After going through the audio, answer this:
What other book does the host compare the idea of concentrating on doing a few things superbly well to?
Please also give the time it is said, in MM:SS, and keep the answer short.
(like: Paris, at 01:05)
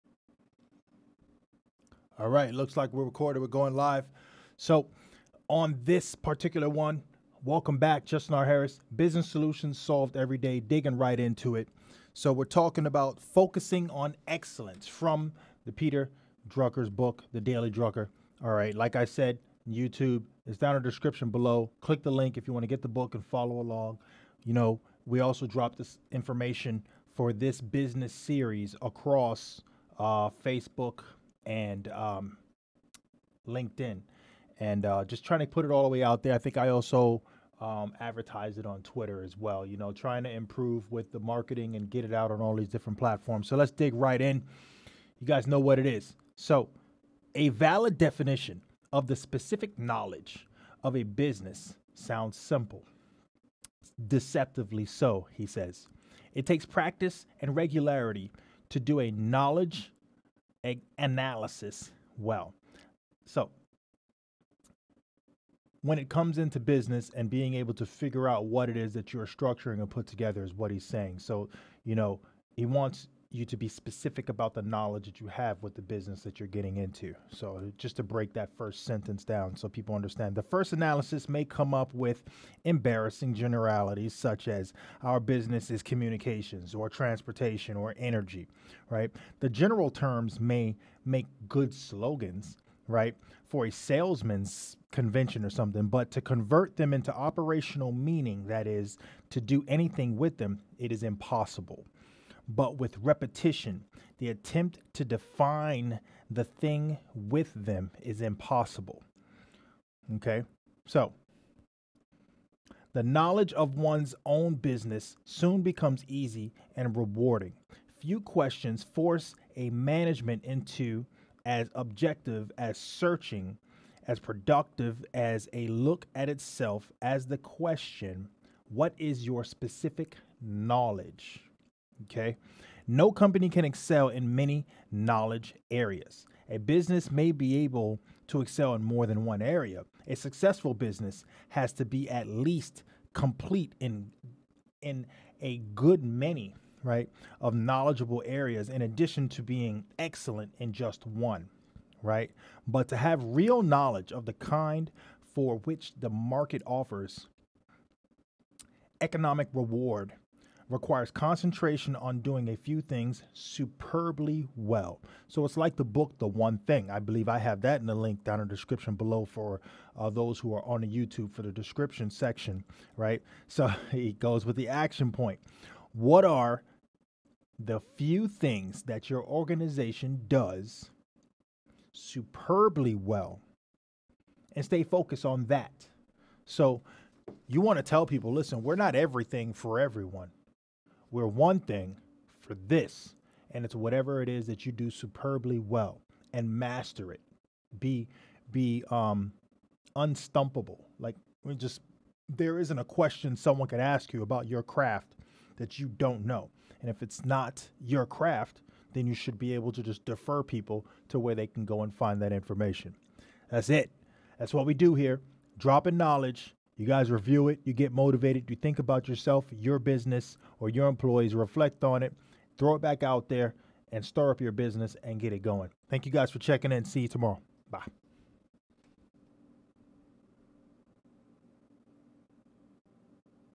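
The One Thing, at 02:46.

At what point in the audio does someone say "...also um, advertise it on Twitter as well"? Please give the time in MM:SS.
00:36.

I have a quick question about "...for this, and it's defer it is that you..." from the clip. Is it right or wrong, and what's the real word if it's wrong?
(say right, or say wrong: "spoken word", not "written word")
wrong: "whatever", not "defer".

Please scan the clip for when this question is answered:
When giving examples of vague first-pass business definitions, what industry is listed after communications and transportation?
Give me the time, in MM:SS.
01:27.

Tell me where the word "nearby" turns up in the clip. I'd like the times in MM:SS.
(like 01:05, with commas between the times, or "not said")
not said.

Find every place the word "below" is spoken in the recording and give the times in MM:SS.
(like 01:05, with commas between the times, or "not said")
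00:21, 02:48.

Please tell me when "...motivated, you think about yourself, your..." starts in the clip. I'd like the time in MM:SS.
03:37.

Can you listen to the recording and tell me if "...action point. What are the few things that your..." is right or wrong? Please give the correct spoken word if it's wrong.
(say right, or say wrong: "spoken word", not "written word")
right.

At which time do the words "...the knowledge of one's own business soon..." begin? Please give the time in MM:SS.
01:52.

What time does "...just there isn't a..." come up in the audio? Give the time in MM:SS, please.
03:21.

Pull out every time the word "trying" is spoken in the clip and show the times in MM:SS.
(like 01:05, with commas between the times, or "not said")
00:35, 00:39.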